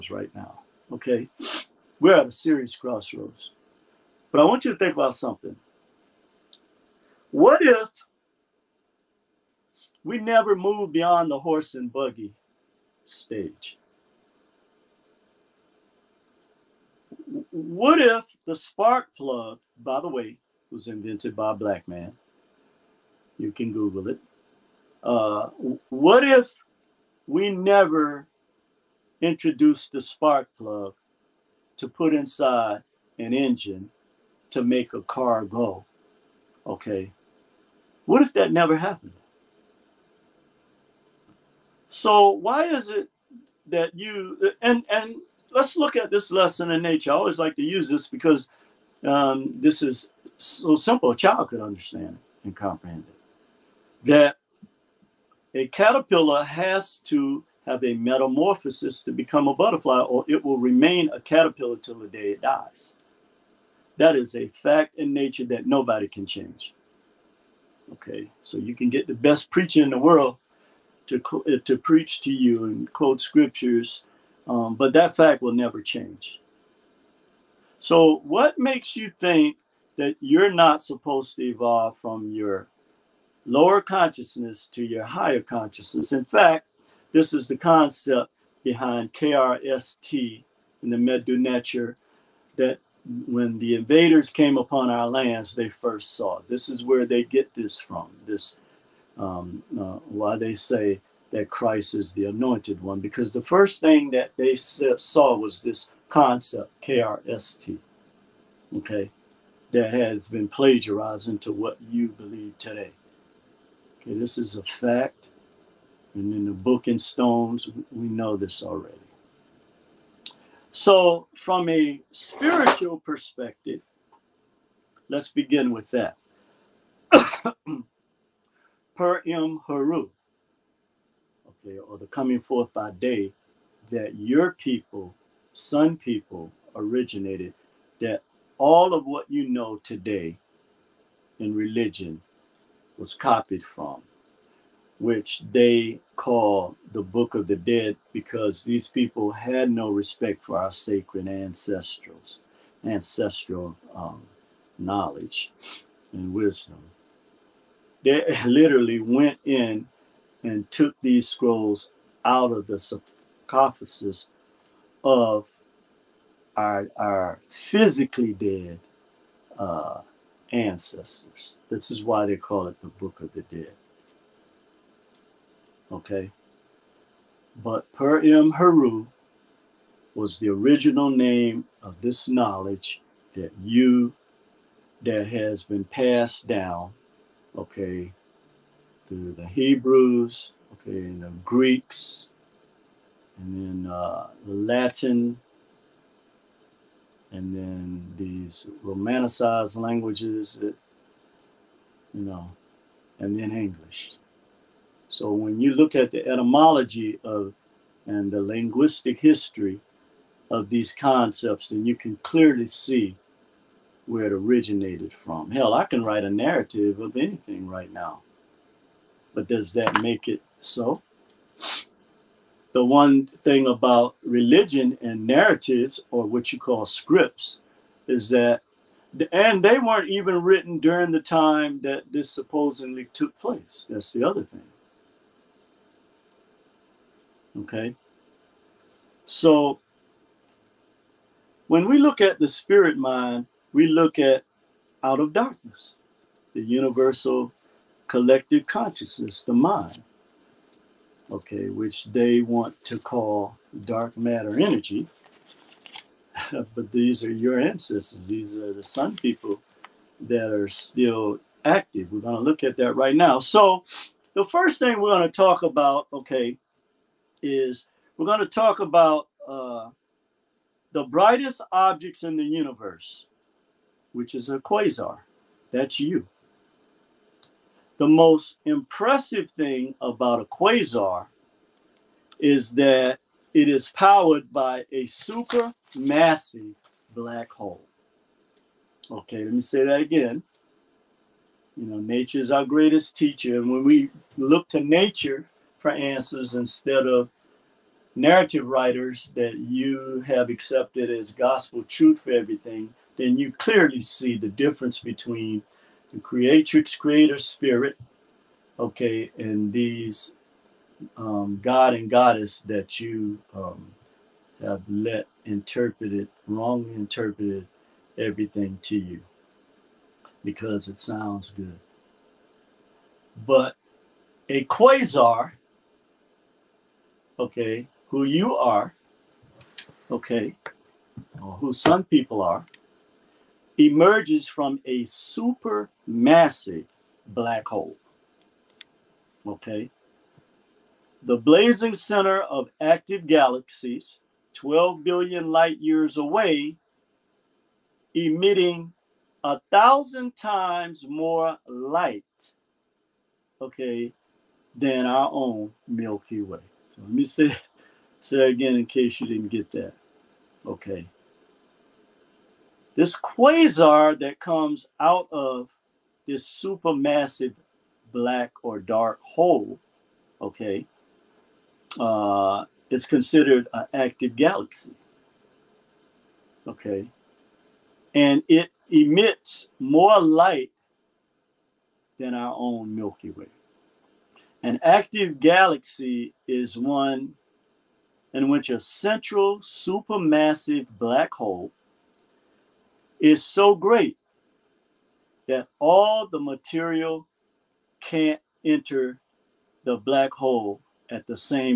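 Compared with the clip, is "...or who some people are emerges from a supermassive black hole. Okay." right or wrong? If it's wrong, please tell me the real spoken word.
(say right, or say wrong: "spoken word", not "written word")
right.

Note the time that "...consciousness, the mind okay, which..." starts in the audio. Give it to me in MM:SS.
04:08.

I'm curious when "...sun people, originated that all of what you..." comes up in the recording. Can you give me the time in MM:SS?
02:15.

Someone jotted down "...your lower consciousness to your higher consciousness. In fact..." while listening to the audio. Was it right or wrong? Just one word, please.
right.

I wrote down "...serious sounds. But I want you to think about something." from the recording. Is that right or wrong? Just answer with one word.
wrong.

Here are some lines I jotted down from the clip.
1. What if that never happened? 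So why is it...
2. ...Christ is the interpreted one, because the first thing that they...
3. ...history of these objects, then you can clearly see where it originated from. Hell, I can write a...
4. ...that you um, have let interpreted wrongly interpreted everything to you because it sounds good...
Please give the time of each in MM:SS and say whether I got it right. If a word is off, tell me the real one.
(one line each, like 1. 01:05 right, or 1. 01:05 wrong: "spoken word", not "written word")
1. 00:38 right
2. 01:41 wrong: "anointed", not "interpreted"
3. 03:29 wrong: "concepts", not "objects"
4. 05:12 right.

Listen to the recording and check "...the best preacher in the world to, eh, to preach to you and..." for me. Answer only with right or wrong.
right.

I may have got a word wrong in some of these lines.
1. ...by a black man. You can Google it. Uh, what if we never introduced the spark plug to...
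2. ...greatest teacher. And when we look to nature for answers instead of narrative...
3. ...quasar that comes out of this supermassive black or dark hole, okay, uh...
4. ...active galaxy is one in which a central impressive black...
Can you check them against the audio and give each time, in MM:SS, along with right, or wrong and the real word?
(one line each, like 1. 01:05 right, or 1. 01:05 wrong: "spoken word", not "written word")
1. 00:21 right
2. 04:52 right
3. 06:03 right
4. 06:24 wrong: "supermassive", not "impressive".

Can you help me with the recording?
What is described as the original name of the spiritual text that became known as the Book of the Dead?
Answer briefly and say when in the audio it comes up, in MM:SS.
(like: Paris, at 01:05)
Per M. Haru, at 02:57.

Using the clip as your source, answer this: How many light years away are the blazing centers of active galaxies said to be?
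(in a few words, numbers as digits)
12 billion light years.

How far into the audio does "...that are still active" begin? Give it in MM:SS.
04:20.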